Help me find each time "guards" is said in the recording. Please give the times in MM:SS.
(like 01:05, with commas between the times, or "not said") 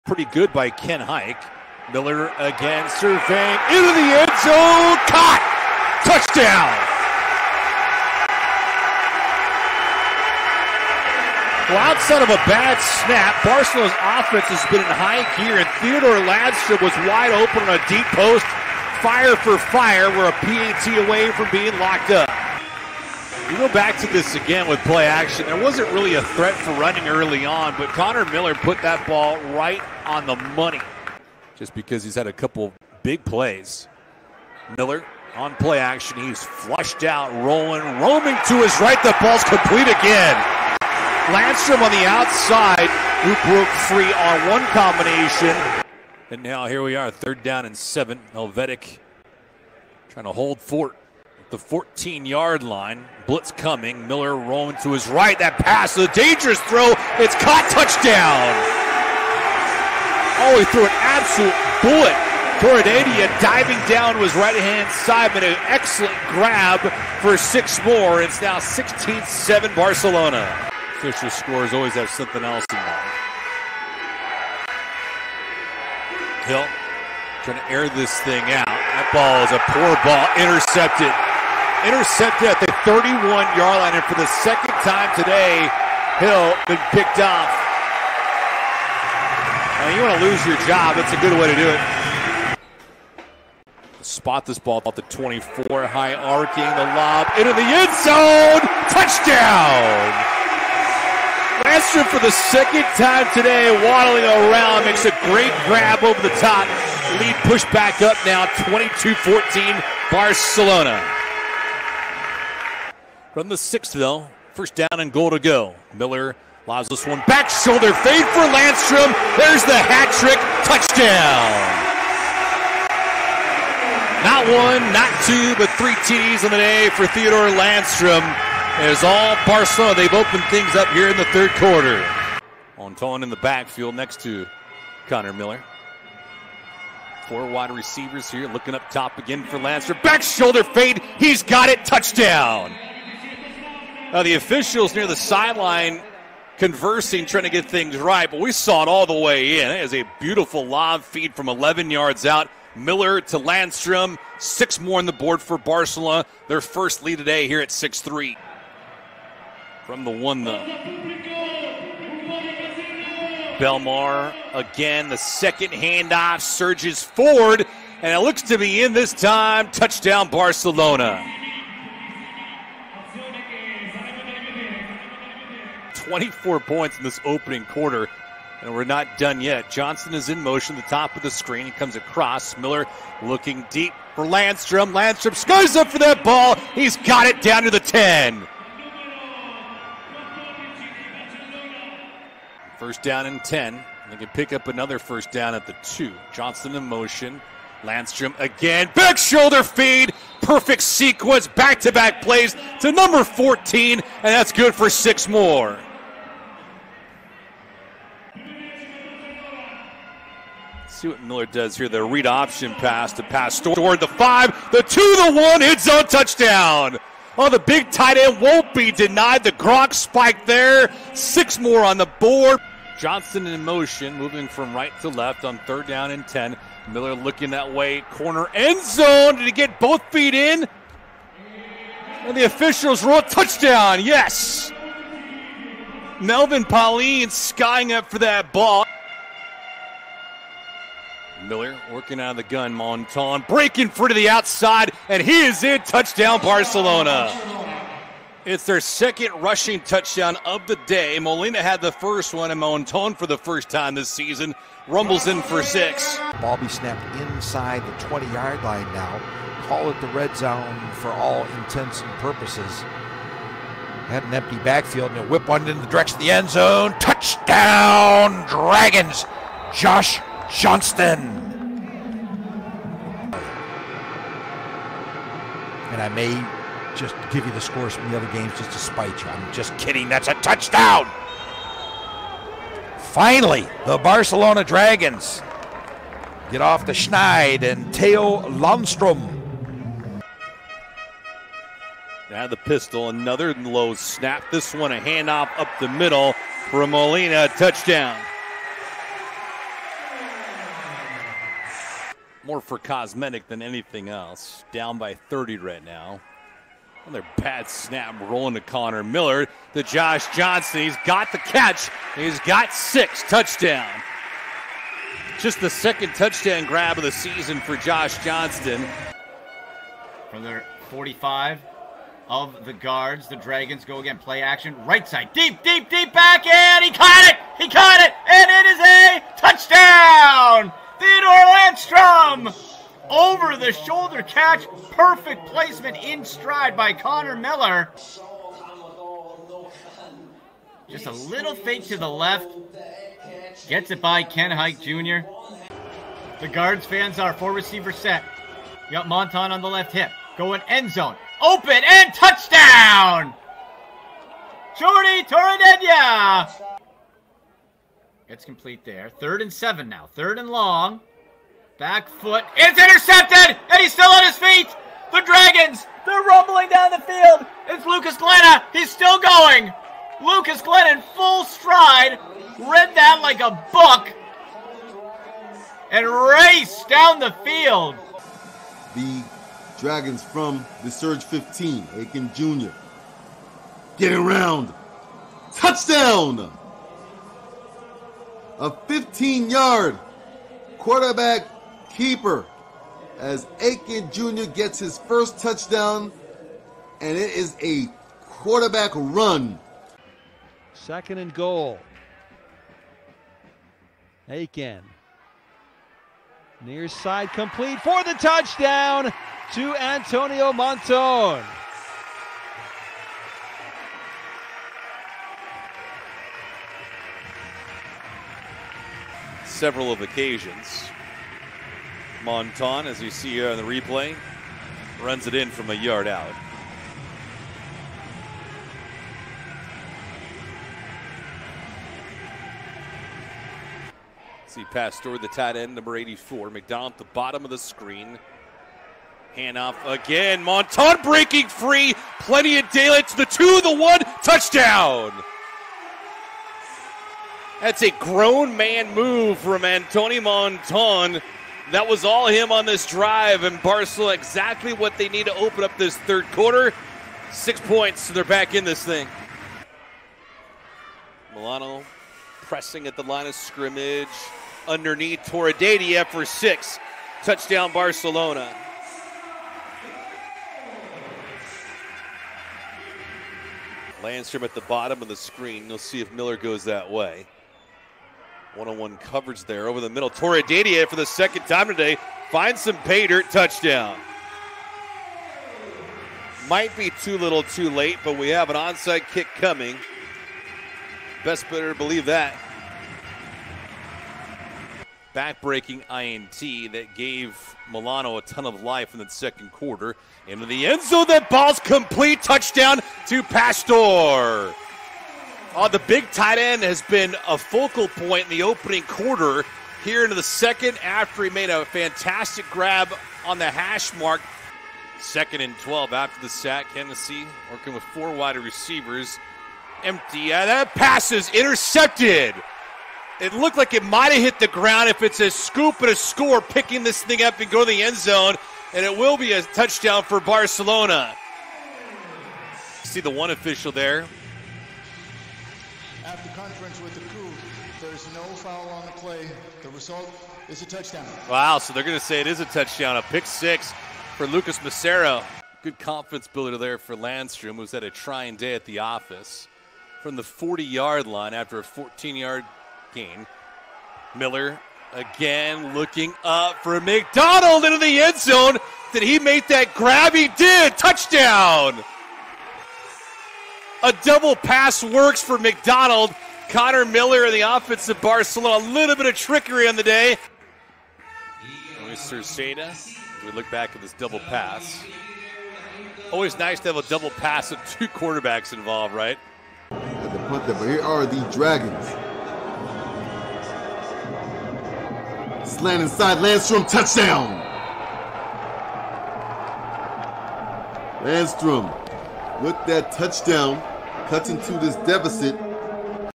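05:22, 05:46.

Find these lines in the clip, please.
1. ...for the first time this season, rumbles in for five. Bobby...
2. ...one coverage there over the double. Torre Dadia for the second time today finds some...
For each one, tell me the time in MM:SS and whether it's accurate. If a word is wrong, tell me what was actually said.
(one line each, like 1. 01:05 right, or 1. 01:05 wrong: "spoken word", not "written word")
1. 04:13 wrong: "six", not "five"
2. 07:58 wrong: "middle", not "double".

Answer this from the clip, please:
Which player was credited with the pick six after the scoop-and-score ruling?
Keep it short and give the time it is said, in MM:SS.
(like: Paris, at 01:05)
Lucas Macero, at 09:04.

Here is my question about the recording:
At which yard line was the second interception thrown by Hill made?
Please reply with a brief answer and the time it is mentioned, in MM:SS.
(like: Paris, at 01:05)
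31-yard line, at 01:22.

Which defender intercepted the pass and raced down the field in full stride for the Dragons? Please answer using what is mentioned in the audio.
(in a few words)
Lucas Glenn.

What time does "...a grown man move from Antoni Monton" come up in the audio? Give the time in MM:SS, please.
07:27.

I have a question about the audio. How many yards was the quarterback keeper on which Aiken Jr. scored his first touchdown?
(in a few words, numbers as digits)
15.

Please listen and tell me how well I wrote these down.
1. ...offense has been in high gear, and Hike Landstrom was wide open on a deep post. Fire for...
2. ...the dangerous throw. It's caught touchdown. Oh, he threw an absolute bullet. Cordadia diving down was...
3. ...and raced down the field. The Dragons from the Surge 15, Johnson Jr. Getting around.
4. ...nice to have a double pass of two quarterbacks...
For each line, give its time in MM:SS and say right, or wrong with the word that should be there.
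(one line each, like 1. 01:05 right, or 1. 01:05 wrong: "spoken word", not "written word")
1. 00:14 wrong: "Theodore", not "Hike"
2. 00:55 right
3. 06:15 wrong: "Aiken", not "Johnson"
4. 09:36 right.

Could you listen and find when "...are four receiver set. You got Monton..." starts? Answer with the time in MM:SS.
05:47.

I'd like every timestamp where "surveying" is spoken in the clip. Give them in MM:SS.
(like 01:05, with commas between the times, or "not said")
00:02.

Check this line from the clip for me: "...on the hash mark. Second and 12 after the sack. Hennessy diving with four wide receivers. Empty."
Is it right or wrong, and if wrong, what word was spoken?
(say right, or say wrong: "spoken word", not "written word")
wrong: "working", not "diving".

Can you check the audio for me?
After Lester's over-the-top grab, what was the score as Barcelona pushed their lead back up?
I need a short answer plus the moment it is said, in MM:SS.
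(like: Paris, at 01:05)
22-14, at 01:48.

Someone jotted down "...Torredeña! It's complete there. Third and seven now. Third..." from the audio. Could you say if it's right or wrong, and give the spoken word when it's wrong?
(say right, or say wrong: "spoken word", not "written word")
right.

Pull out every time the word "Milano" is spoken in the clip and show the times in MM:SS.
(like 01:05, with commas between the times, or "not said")
07:41, 08:17.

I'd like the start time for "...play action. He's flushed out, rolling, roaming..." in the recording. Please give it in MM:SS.
00:35.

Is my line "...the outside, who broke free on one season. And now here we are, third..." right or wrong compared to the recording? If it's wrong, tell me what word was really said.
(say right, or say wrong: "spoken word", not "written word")
wrong: "combination", not "season".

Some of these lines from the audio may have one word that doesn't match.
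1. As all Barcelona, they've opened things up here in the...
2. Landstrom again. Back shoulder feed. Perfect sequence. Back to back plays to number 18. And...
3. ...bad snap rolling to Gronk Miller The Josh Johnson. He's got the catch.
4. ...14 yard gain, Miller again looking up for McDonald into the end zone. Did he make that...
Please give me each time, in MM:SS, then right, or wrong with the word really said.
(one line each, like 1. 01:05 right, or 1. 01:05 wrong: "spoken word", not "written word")
1. 02:08 right
2. 03:17 wrong: "14", not "18"
3. 05:07 wrong: "Connor", not "Gronk"
4. 09:11 right.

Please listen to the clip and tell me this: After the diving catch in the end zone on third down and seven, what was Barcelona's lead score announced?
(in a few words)
16-7.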